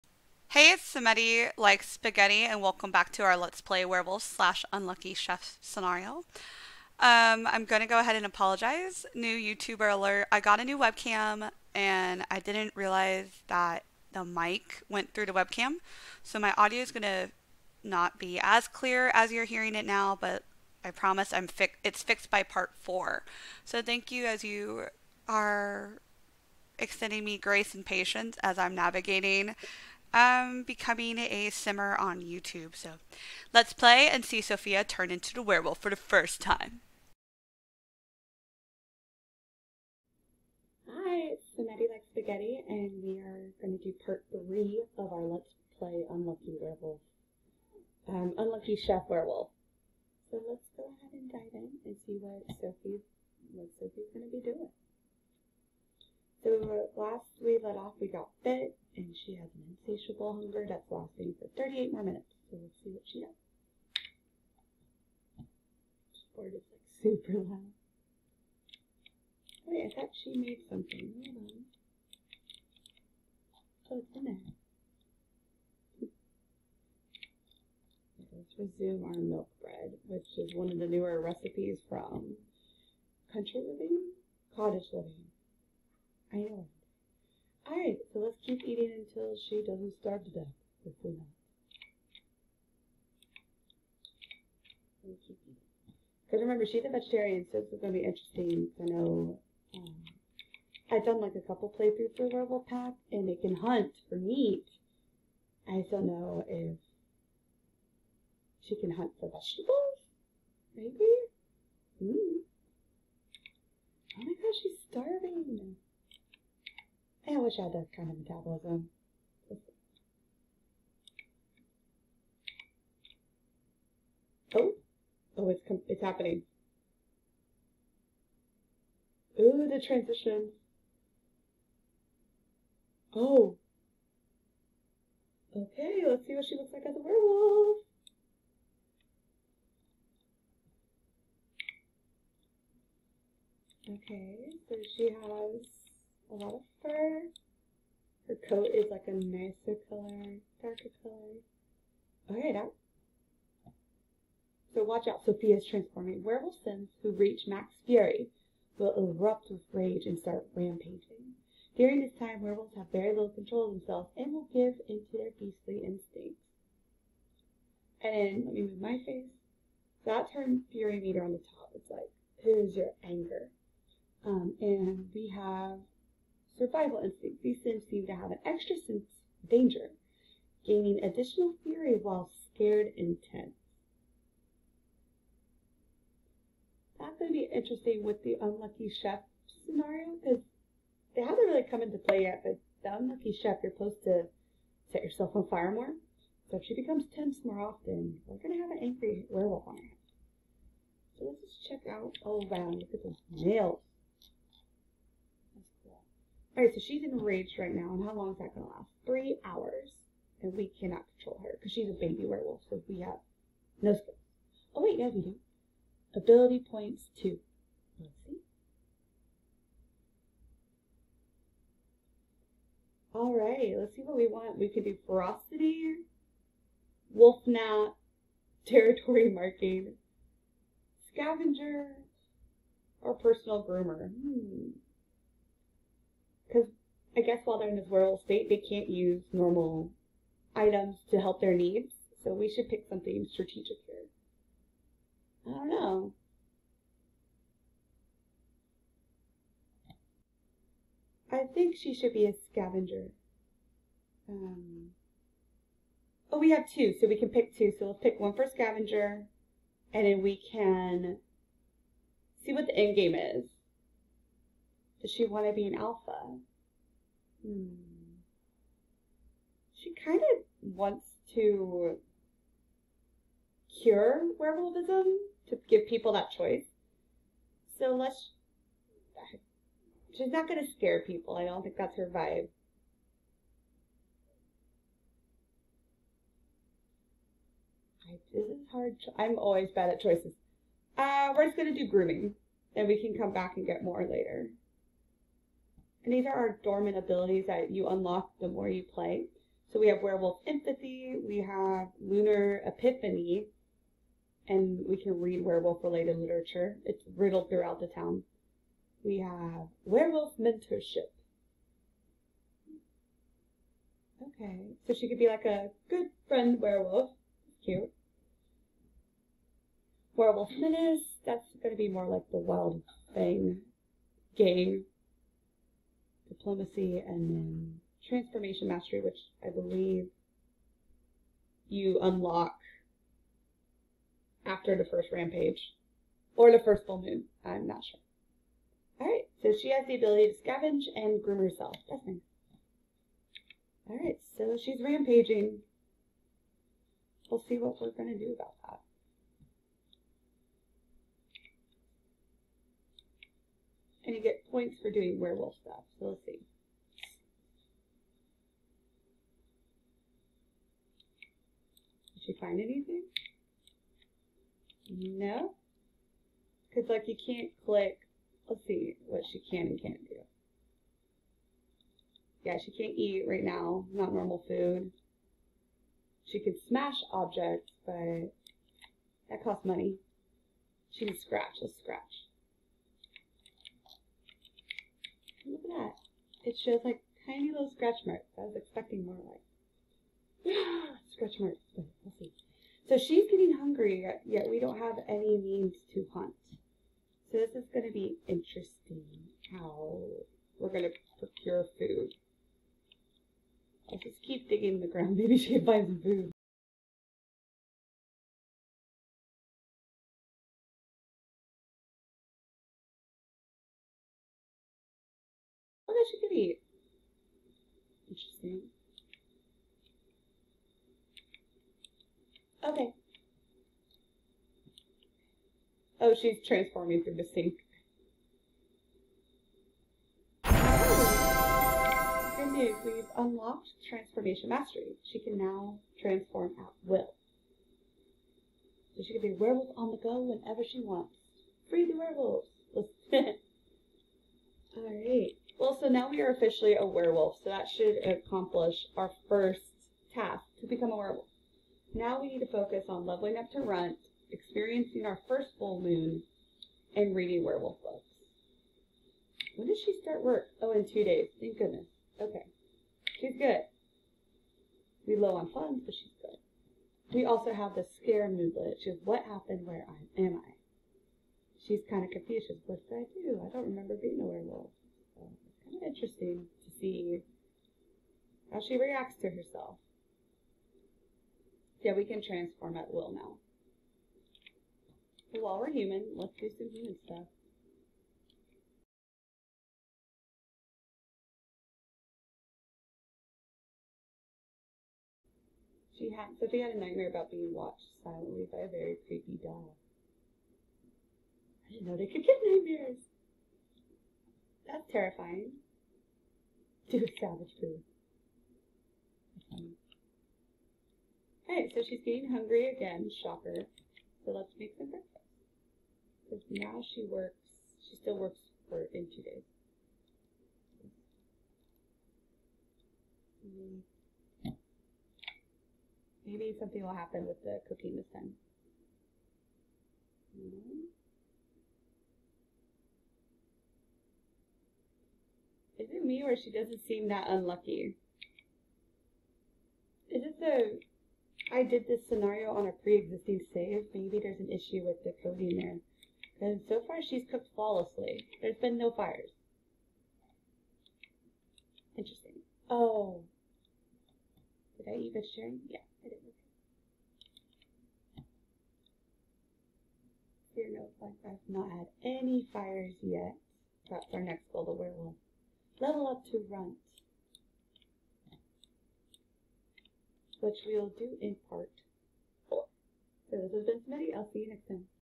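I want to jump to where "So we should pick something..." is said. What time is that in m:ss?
4:02.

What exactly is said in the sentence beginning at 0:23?
So thank you as you are extending me grace and patience as I'm navigating um, becoming a simmer on YouTube.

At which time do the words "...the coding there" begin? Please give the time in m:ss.
9:05.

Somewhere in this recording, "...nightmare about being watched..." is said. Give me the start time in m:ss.
8:16.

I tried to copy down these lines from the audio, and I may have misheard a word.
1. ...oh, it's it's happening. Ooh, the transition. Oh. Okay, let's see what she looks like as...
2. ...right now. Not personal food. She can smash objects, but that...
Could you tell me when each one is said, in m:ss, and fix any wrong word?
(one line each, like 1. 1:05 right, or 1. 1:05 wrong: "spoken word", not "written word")
1. 2:05 right
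2. 6:13 wrong: "normal", not "personal".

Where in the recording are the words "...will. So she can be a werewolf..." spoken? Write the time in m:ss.
7:16.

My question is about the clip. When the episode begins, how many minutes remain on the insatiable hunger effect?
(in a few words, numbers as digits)
38.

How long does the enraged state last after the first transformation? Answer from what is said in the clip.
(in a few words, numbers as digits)
Three hours.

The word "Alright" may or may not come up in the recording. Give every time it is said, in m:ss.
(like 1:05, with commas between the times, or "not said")
1:27, 7:24.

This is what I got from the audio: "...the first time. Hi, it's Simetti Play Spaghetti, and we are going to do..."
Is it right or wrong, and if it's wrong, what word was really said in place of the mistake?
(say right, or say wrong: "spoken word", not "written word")
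wrong: "Like", not "Play".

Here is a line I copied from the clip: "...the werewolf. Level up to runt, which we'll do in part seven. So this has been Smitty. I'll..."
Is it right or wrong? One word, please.
wrong.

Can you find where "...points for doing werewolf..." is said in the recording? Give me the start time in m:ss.
5:54.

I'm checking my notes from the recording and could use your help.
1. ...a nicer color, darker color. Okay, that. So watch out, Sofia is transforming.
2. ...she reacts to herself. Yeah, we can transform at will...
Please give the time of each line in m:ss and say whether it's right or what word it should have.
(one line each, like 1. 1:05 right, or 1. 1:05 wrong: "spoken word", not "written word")
1. 2:29 right
2. 7:58 right.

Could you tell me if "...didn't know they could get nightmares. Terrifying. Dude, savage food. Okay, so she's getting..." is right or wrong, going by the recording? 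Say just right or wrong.
right.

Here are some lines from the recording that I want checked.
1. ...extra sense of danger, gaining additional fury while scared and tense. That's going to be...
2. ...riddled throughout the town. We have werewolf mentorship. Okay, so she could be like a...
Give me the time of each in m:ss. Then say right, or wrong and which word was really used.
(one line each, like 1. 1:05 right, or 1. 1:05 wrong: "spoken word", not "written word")
1. 2:58 right
2. 5:07 right.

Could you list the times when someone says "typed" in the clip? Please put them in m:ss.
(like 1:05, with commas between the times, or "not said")
not said.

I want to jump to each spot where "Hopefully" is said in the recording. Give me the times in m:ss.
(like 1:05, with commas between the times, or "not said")
1:30.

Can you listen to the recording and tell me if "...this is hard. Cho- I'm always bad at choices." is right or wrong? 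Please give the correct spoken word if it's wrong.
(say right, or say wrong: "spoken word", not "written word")
right.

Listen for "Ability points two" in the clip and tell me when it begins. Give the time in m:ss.
3:36.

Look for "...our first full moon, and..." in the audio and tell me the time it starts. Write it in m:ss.
7:35.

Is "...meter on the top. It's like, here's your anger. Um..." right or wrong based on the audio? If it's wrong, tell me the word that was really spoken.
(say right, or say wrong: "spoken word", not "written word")
right.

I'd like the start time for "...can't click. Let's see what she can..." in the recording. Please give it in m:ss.
6:07.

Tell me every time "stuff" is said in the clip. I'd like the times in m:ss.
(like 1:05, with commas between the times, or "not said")
5:55, 8:07.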